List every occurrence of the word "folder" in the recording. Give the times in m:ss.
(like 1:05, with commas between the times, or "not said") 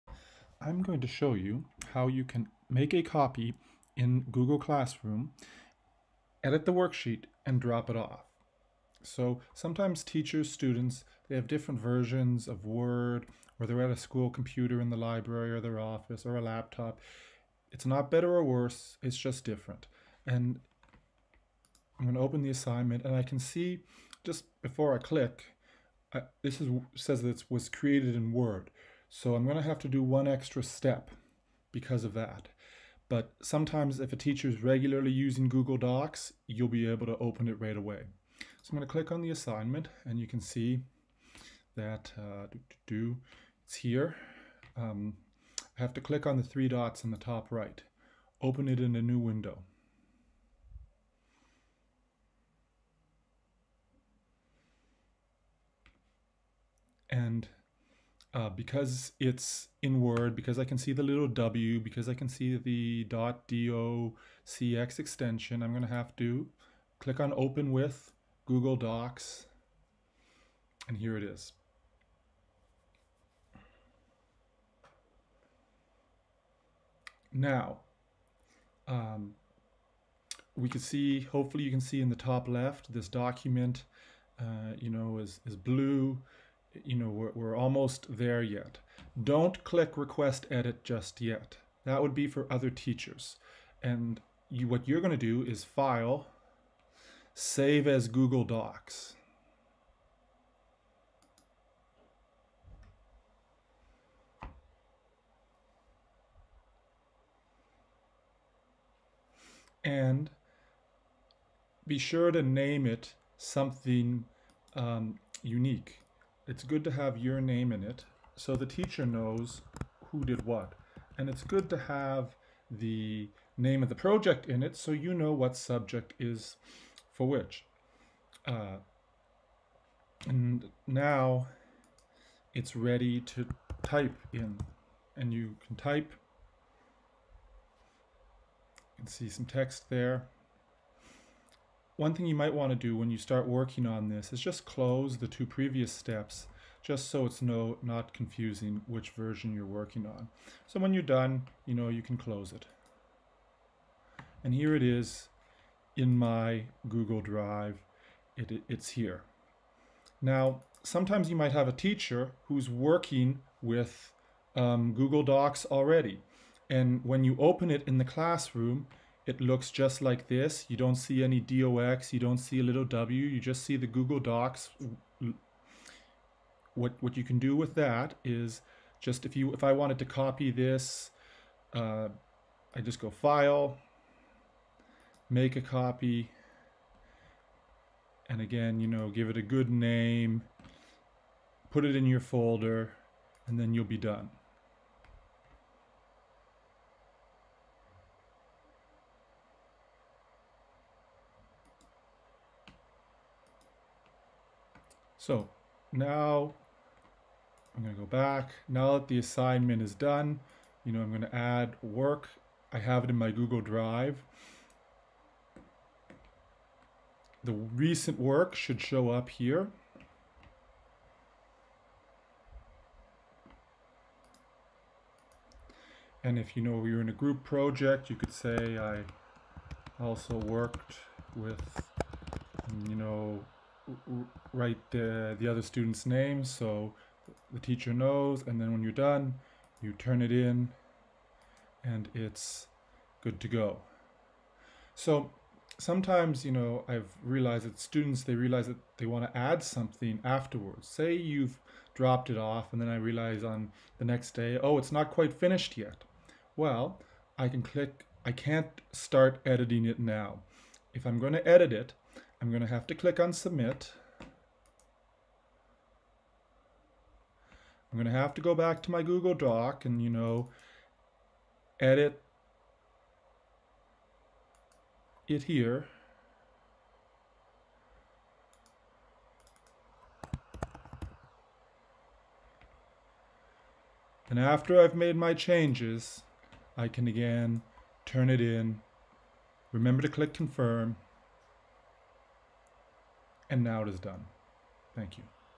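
3:12.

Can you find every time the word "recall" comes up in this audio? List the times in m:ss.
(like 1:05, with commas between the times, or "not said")
not said.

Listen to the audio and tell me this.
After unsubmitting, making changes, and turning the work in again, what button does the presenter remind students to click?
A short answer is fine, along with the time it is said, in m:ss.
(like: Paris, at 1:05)
Confirm, at 4:50.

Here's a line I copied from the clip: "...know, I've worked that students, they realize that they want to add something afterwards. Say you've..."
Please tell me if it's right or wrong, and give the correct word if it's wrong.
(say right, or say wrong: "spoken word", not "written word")
wrong: "realized", not "worked".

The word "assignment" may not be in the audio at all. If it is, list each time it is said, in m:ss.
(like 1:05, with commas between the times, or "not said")
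0:22, 0:39, 3:29.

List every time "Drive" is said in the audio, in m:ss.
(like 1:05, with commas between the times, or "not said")
2:37, 3:33.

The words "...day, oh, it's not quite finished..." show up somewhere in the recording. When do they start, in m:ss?
4:14.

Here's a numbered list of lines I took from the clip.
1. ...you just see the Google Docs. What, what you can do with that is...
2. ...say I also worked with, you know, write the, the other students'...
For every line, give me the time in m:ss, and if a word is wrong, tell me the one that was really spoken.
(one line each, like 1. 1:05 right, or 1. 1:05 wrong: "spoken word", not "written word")
1. 2:53 right
2. 3:48 right.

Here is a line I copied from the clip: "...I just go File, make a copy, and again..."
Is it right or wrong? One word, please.
right.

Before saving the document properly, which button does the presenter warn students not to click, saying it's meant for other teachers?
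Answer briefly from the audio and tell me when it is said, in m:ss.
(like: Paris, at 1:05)
Request edit, at 1:29.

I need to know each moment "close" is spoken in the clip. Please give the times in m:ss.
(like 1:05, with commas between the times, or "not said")
2:24, 2:32.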